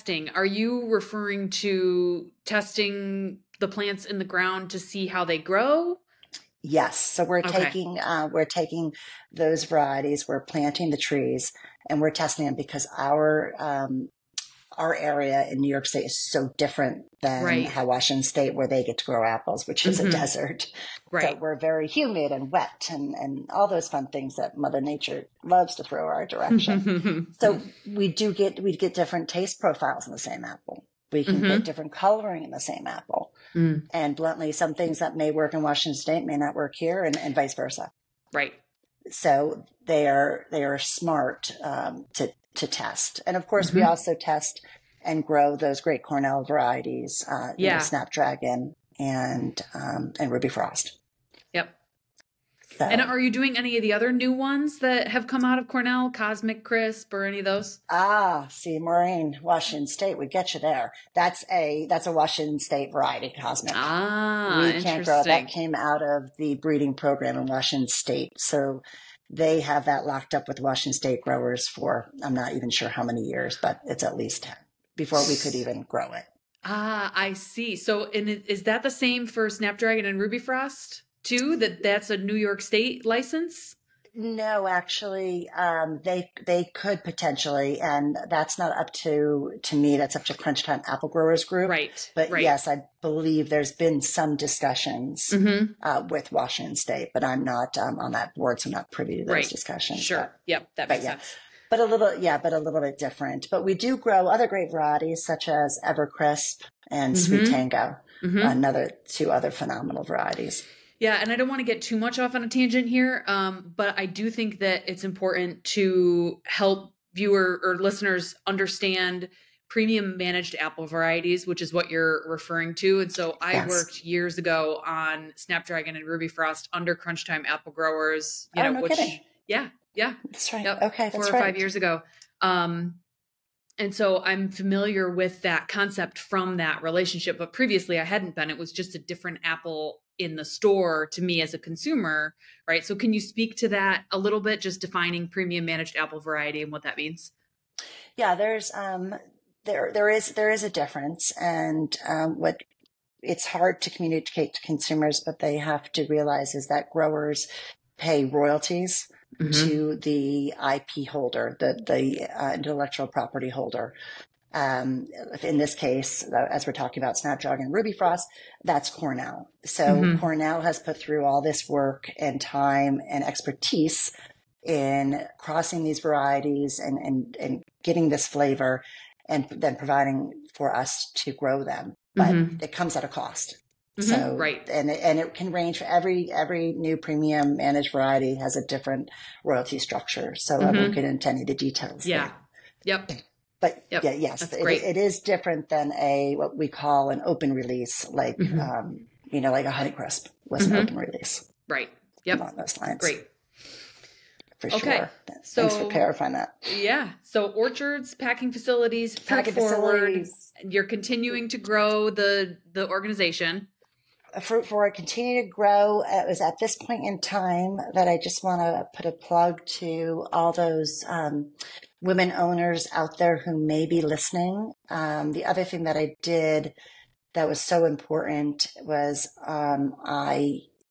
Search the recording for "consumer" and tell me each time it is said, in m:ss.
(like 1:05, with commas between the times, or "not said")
2:21, 2:34.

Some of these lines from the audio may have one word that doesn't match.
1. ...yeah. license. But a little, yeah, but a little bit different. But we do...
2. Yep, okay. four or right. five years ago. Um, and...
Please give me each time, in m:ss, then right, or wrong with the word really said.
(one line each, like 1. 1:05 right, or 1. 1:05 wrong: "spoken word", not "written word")
1. 1:41 wrong: "sense", not "license"
2. 2:10 right.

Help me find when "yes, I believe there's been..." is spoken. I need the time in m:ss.
1:32.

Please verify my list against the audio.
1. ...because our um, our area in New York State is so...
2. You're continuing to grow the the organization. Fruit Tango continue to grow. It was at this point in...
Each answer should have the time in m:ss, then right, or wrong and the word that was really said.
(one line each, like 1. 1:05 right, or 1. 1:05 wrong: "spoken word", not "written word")
1. 0:12 right
2. 3:30 wrong: "Forward", not "Tango".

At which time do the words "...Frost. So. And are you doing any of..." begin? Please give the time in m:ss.
0:50.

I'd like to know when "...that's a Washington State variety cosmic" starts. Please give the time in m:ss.
1:01.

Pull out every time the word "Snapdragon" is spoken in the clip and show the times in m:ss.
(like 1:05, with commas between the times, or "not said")
0:47, 1:19, 2:05, 2:47.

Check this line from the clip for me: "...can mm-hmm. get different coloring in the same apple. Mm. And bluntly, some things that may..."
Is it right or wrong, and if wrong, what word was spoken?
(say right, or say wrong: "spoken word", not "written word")
right.